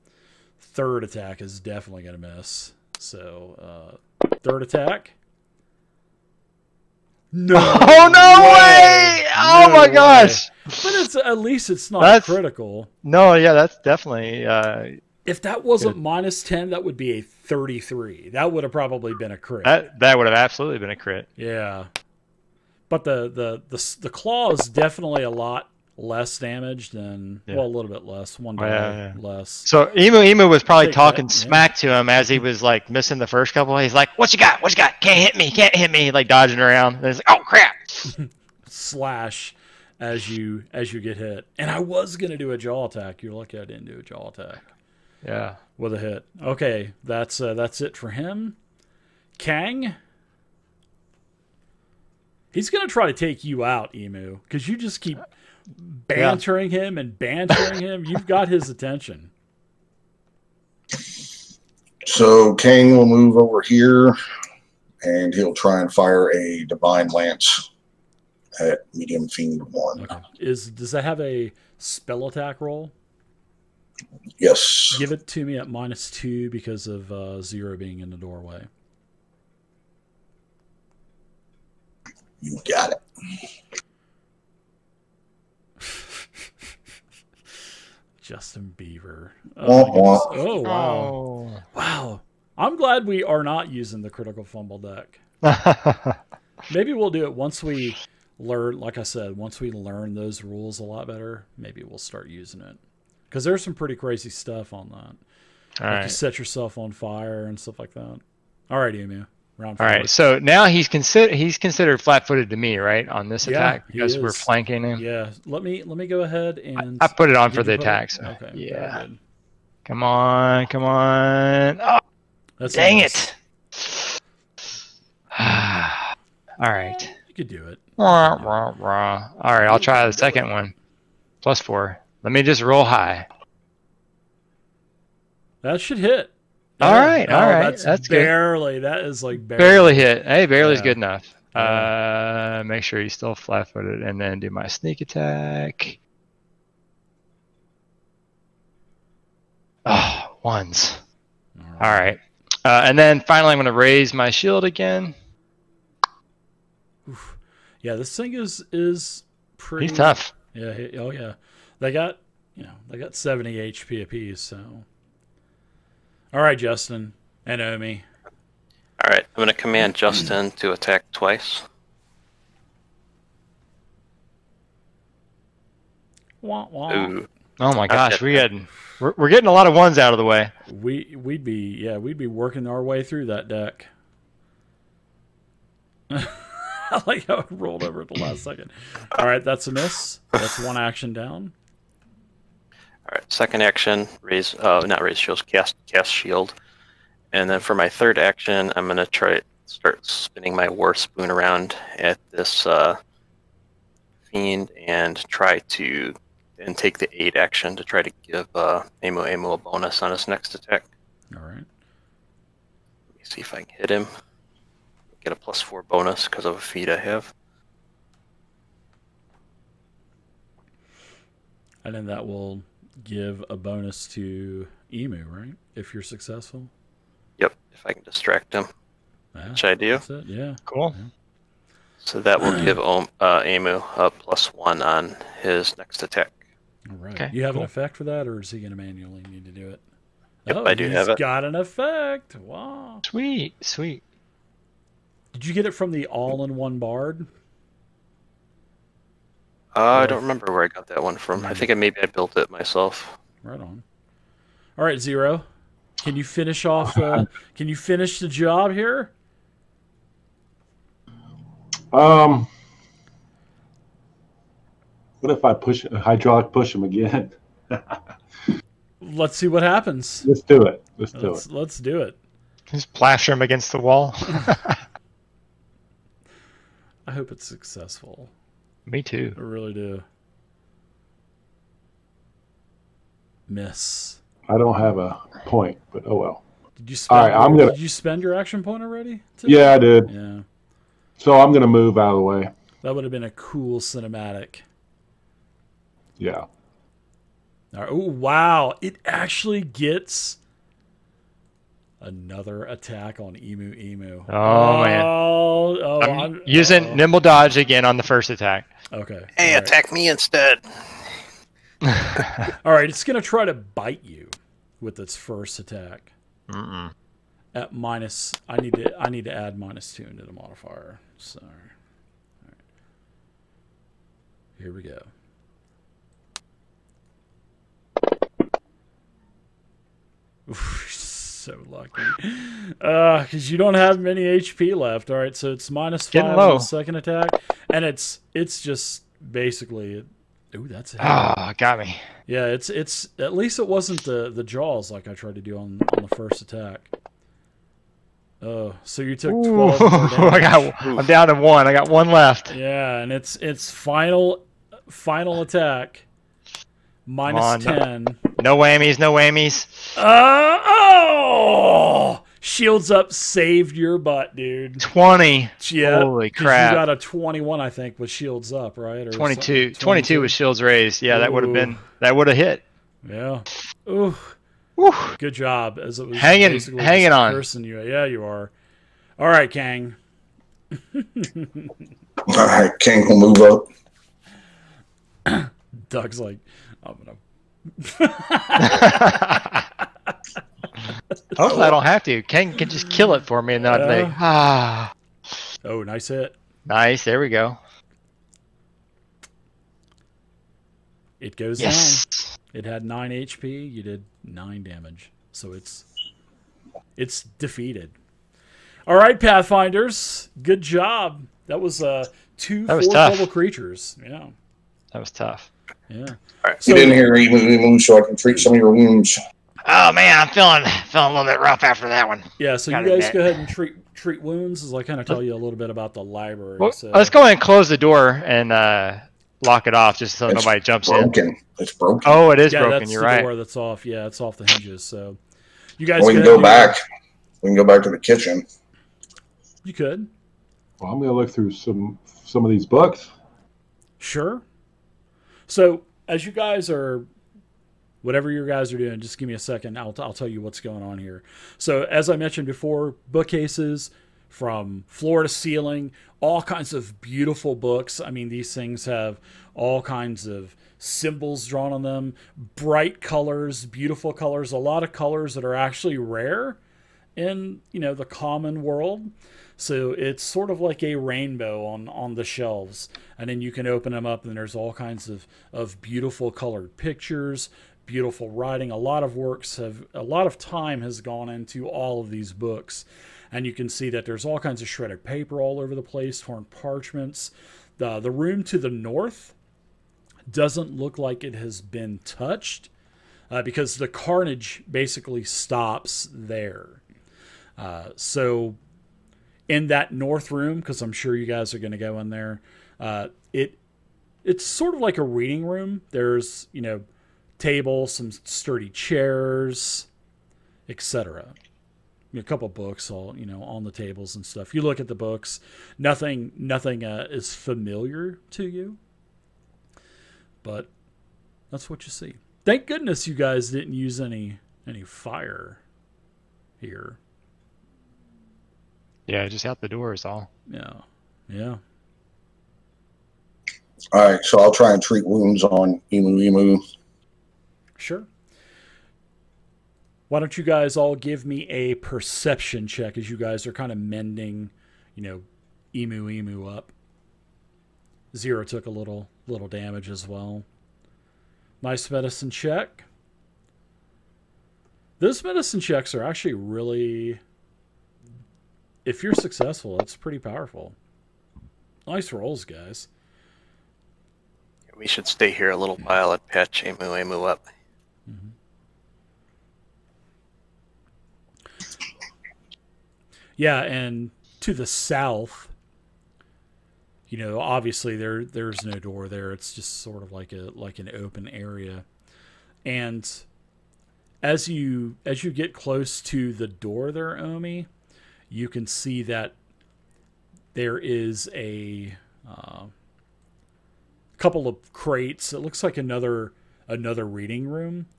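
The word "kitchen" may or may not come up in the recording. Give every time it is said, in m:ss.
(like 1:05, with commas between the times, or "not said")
7:17.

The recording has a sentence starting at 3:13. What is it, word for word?
All right, second action, raise, uh, not raise shields, cast, cast shield.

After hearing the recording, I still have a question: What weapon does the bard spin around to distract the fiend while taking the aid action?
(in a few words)
war spoon.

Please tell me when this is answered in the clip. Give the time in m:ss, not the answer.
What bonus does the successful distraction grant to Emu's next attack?
3:54.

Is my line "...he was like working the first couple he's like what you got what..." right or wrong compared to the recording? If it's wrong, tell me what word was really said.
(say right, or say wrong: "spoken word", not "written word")
wrong: "missing", not "working".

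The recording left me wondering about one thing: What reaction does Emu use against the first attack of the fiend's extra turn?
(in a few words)
Nimble Dodge.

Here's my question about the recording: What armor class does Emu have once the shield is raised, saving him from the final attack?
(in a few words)
22.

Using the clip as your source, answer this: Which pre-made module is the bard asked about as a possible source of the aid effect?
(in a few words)
all-in-one bard.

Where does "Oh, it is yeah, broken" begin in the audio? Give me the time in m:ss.
7:12.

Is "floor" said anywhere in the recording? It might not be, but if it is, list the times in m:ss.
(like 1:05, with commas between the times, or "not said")
7:34.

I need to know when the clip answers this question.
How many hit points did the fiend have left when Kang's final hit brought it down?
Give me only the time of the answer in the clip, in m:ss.
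6:42.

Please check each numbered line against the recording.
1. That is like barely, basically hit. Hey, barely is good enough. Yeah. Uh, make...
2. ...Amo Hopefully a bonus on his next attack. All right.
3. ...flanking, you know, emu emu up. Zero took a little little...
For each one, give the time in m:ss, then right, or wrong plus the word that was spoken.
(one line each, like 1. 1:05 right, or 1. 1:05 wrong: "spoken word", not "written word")
1. 2:18 wrong: "barely", not "basically"
2. 3:29 wrong: "Amo", not "Hopefully"
3. 9:03 wrong: "mending", not "flanking".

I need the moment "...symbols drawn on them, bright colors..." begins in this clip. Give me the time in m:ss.
7:40.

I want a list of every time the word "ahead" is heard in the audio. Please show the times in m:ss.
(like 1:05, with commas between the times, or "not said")
1:56, 7:03, 7:07.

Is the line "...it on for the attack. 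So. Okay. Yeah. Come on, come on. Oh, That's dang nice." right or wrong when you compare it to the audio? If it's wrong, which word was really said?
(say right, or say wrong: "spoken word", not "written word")
right.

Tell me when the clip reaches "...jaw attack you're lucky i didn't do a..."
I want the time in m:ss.
0:42.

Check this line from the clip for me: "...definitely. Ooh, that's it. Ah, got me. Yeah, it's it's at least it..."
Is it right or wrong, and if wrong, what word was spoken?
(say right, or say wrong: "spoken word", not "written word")
wrong: "basically", not "definitely".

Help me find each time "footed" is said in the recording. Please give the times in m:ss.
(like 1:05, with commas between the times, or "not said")
1:51, 2:23.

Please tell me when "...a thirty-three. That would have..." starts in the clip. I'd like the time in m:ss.
0:17.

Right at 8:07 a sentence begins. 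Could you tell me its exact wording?
The, the room to the north doesn't look like it has been touched uh, because the carnage basically stops there.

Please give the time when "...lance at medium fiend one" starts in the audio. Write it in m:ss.
1:07.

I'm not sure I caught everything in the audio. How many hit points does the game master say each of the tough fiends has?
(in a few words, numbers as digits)
70.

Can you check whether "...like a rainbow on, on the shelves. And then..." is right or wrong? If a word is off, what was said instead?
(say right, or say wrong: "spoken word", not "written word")
right.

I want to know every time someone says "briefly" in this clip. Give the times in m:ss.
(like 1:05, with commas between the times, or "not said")
not said.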